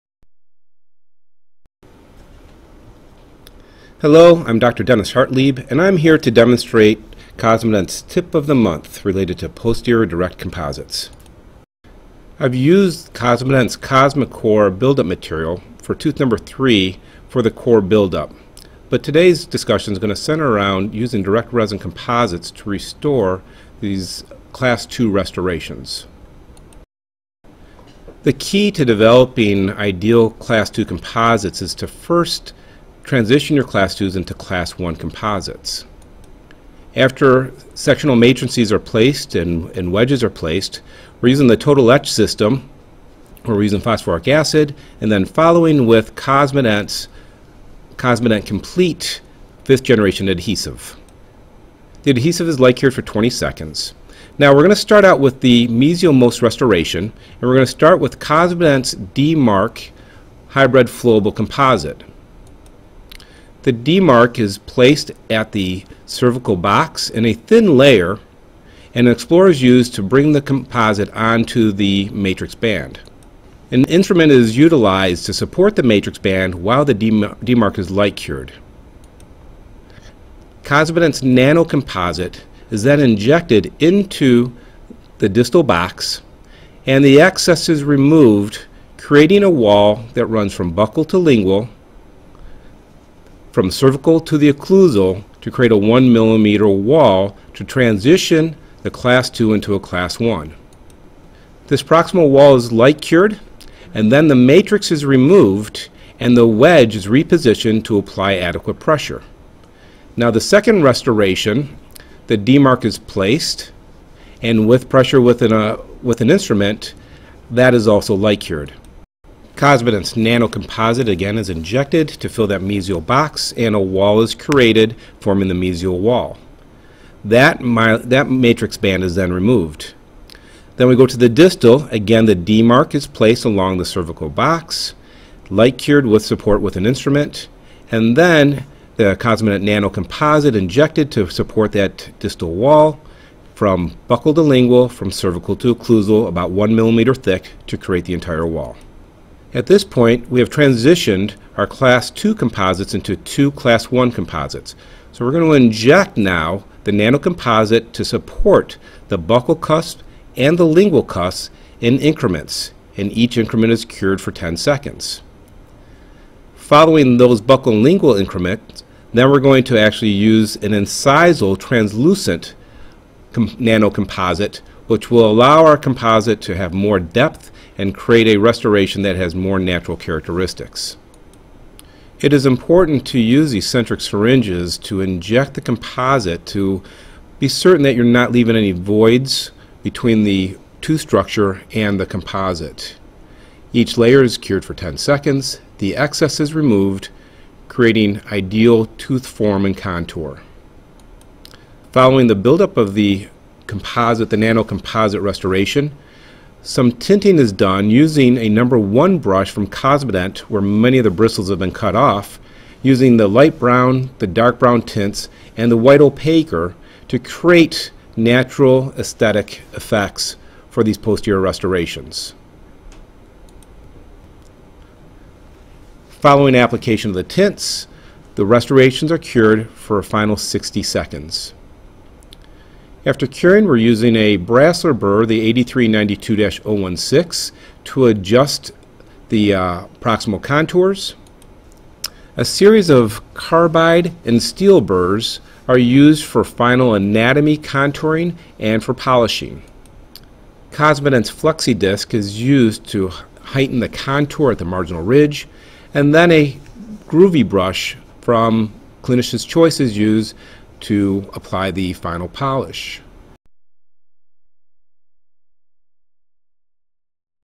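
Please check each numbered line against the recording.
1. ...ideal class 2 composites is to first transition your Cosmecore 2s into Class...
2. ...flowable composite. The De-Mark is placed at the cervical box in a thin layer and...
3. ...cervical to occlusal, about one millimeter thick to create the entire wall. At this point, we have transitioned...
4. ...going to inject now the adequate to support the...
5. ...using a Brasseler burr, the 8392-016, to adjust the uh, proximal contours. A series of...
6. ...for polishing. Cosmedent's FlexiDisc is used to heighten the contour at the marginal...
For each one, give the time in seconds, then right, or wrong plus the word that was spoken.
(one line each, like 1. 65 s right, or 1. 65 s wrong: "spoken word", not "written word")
1. 29 s wrong: "Class", not "Cosmecore"
2. 60 s right
3. 145 s right
4. 155 s wrong: "nanocomposite", not "adequate"
5. 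233 s right
6. 248 s right.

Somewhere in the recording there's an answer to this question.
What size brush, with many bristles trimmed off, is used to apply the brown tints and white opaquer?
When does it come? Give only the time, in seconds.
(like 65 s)
208 s.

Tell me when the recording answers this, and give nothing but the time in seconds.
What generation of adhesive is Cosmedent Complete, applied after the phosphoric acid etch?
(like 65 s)
49 s.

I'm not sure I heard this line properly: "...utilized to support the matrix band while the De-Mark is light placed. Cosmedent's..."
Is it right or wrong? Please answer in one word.
wrong.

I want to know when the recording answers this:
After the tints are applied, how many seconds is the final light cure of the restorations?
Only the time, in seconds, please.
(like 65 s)
230 s.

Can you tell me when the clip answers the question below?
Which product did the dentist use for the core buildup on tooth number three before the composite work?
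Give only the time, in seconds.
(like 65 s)
13 s.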